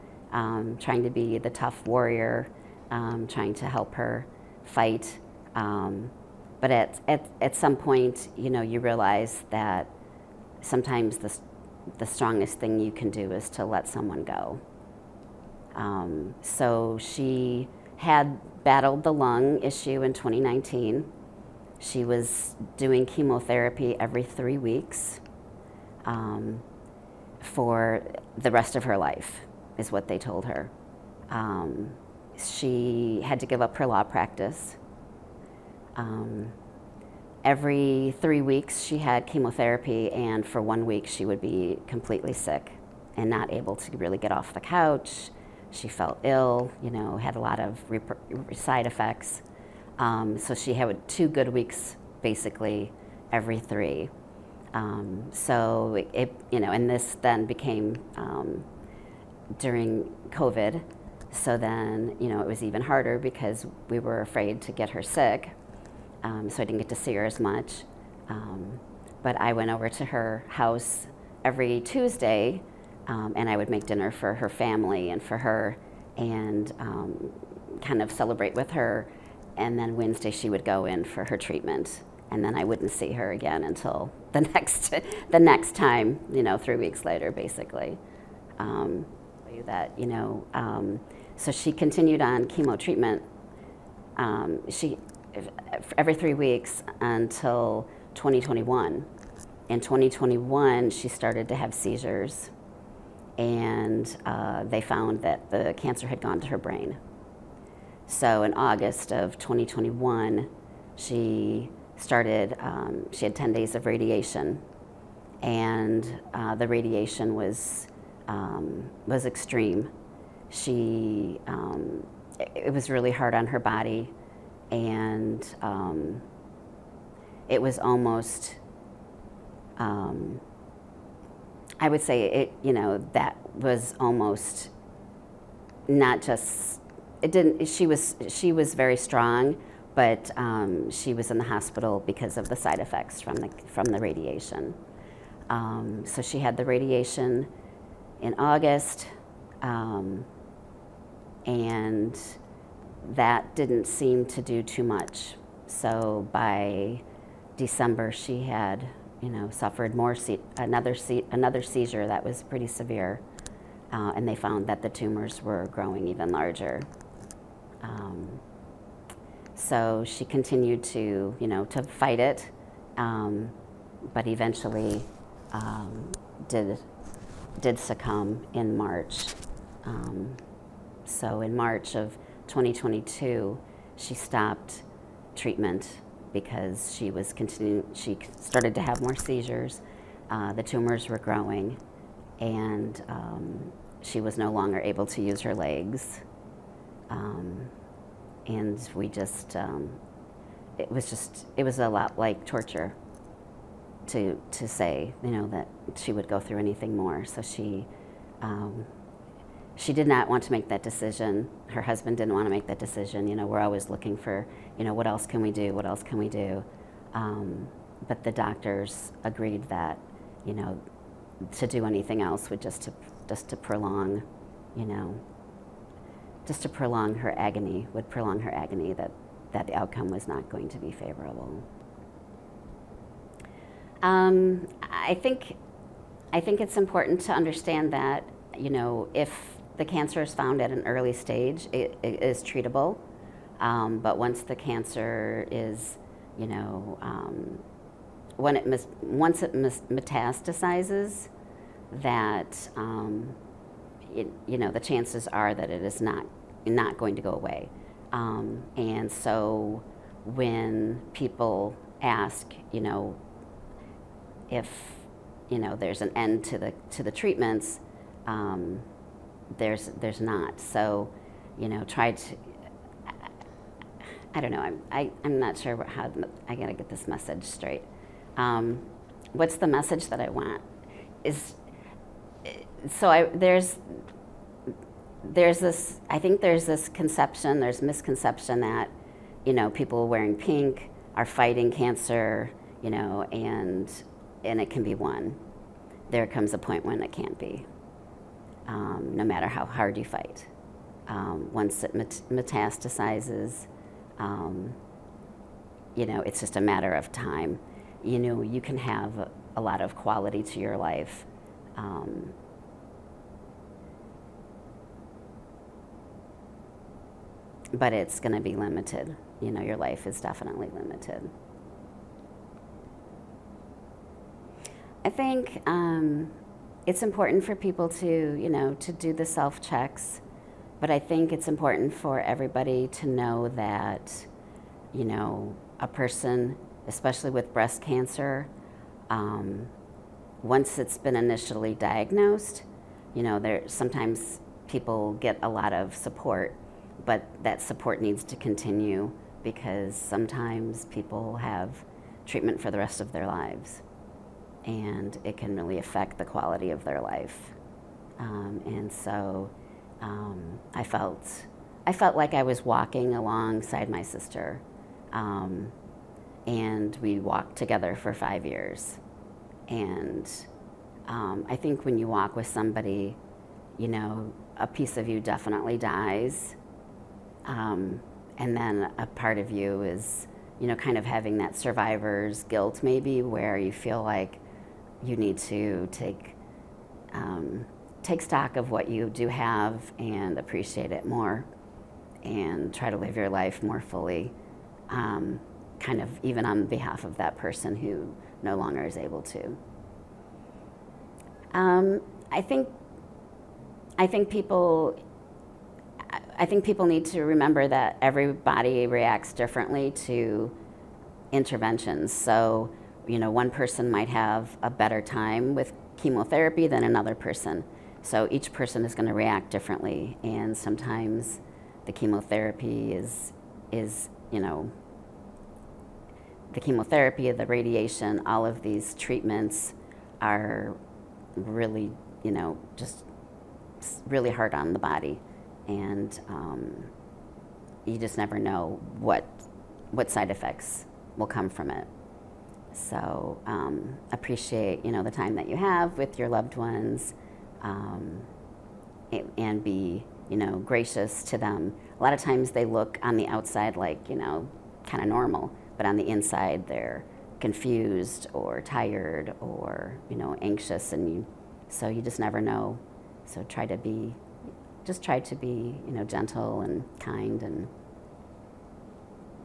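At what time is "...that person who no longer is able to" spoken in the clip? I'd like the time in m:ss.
6:37.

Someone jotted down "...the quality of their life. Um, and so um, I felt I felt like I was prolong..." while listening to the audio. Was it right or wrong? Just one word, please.
wrong.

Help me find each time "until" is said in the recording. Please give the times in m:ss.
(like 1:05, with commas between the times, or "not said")
1:23, 1:36.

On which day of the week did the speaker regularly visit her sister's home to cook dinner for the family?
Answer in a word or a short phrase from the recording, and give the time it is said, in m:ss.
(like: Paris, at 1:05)
Tuesday, at 1:11.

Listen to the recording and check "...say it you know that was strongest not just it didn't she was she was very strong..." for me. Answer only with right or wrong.
wrong.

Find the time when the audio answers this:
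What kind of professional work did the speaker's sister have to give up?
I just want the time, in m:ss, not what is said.
0:33.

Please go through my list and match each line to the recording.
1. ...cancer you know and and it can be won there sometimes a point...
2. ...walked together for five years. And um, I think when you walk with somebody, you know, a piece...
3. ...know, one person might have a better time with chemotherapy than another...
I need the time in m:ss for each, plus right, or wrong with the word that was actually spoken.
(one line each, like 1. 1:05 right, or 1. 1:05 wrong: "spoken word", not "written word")
1. 4:51 wrong: "comes", not "sometimes"
2. 6:07 right
3. 6:53 right.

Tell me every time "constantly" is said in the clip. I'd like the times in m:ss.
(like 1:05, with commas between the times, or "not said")
not said.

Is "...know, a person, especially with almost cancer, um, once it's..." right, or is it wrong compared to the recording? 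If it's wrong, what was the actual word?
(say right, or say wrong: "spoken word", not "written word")
wrong: "breast", not "almost".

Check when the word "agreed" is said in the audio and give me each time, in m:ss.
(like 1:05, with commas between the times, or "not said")
3:39.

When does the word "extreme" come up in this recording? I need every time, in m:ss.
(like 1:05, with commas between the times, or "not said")
1:59.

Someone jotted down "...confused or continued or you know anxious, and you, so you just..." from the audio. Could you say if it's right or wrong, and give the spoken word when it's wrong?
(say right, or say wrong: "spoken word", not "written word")
wrong: "tired", not "continued".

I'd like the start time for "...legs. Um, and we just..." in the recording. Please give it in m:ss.
3:15.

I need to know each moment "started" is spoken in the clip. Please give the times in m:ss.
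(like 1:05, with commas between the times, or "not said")
1:41, 1:51, 3:08.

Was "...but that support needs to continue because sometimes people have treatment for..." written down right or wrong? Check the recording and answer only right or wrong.
right.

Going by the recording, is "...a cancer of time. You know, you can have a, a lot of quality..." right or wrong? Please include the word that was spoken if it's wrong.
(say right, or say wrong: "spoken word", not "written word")
wrong: "matter", not "cancer".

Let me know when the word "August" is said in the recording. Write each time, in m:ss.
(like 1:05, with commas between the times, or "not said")
1:48, 2:28.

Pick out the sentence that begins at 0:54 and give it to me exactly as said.
Um, so it, it, you know, and this then became um, during COVID.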